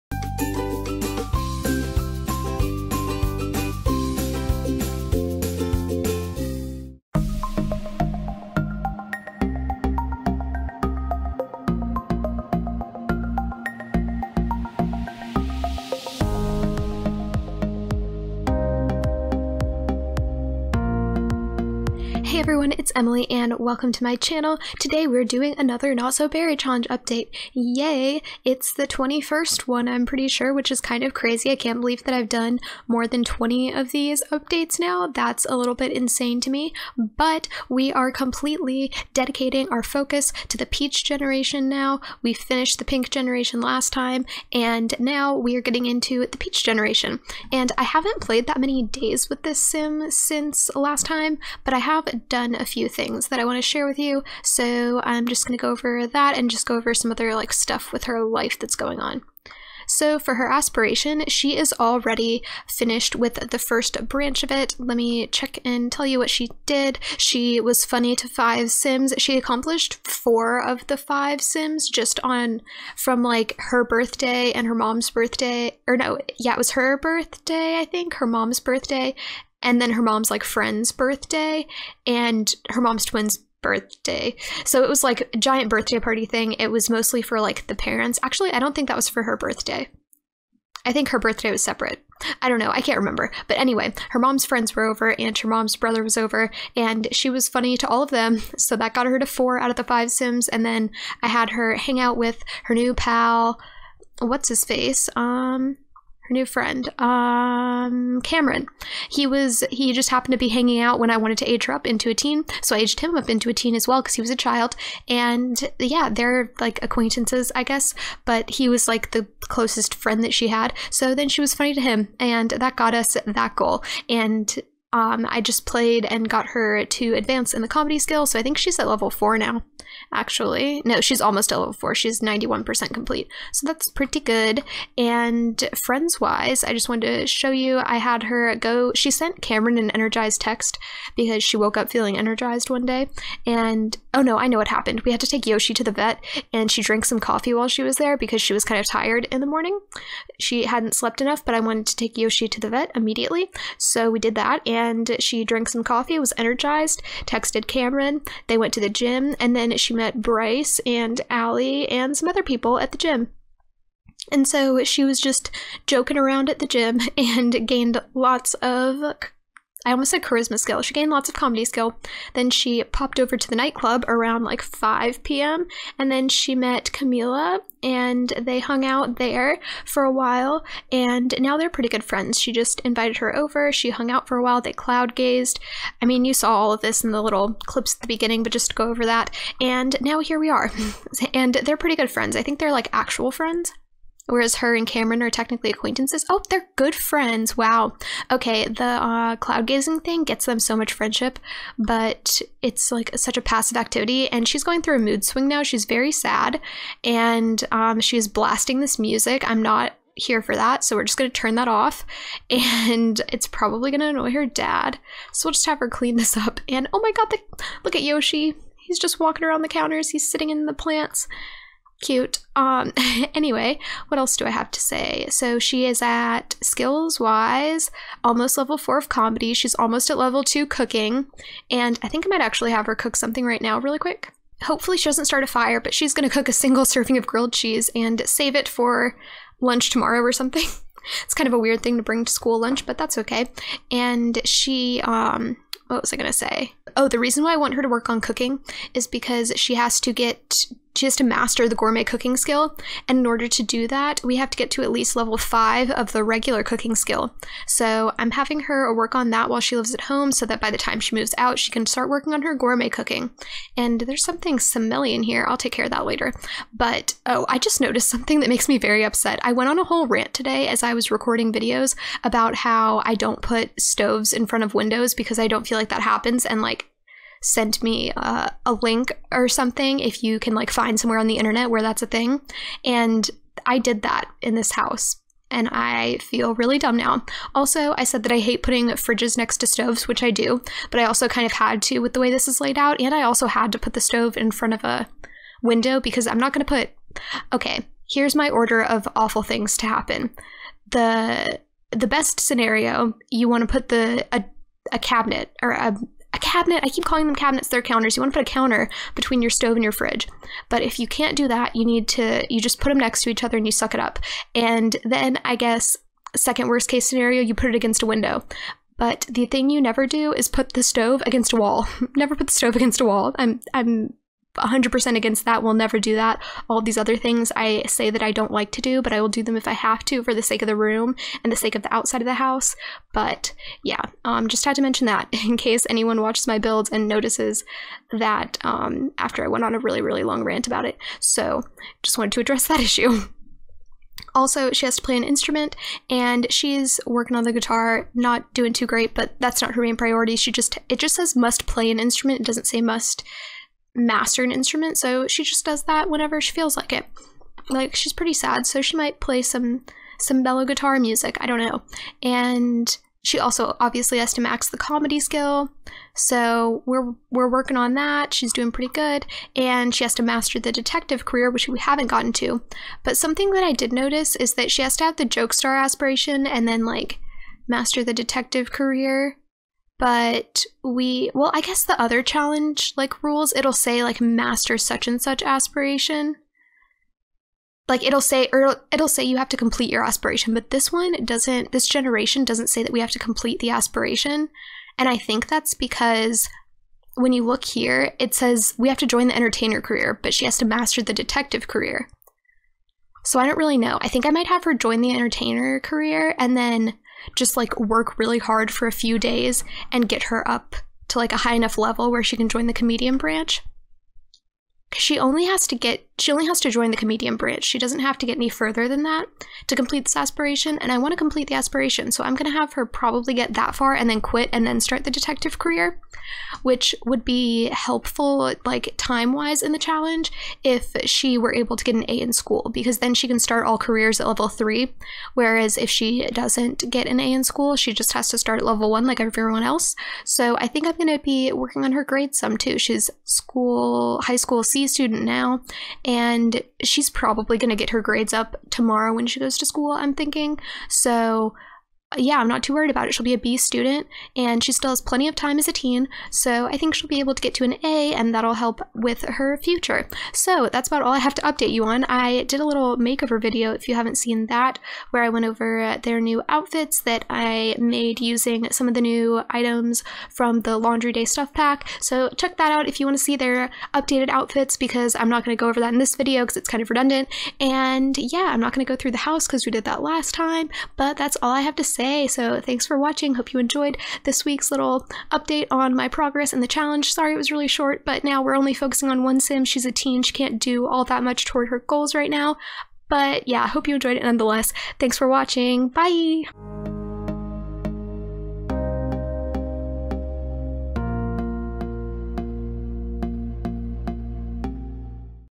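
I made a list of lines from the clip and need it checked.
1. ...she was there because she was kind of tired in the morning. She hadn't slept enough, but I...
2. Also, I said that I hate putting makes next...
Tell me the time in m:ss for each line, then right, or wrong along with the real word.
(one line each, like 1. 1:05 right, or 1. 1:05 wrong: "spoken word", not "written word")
1. 2:27 right
2. 4:47 wrong: "fridges", not "makes".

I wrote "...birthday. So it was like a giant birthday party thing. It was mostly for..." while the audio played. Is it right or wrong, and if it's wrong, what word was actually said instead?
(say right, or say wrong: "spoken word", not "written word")
right.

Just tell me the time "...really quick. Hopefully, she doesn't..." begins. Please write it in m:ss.
3:53.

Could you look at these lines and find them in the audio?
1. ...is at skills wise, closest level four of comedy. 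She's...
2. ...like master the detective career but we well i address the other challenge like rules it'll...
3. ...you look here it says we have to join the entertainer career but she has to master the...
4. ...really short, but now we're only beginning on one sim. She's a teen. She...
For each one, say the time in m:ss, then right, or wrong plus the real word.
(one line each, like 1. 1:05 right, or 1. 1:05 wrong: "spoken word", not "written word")
1. 3:45 wrong: "almost", not "closest"
2. 6:16 wrong: "guess", not "address"
3. 6:37 right
4. 8:07 wrong: "focusing", not "beginning".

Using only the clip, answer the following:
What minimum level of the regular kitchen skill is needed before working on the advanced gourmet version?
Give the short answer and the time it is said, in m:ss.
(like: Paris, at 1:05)
5, at 4:15.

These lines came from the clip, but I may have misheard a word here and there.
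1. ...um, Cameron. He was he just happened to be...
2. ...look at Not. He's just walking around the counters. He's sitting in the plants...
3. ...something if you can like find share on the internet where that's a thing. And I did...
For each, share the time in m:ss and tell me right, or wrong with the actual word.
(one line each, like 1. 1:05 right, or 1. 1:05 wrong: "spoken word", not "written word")
1. 1:46 right
2. 3:37 wrong: "Yoshi", not "Not"
3. 4:39 wrong: "somewhere", not "share".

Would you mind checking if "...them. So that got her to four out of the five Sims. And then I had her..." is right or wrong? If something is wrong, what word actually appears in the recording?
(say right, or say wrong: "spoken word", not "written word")
right.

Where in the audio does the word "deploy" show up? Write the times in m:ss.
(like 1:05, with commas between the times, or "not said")
not said.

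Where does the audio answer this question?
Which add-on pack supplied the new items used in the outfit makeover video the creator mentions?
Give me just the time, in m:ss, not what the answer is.
7:50.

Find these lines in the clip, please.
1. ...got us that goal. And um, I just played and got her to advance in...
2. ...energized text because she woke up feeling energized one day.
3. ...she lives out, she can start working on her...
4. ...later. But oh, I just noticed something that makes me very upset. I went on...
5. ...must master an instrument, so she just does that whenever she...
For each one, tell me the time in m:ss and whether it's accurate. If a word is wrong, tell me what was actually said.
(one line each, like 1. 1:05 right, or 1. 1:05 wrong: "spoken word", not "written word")
1. 2:02 right
2. 2:19 right
3. 4:20 wrong: "moves", not "lives"
4. 4:26 right
5. 5:52 right.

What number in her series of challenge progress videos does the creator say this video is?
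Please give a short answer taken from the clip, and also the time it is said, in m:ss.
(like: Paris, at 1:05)
21st, at 0:28.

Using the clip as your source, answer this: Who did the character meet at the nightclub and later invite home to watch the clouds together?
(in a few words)
Camila.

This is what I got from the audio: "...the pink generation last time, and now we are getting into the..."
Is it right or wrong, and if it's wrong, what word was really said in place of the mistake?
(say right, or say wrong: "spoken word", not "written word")
right.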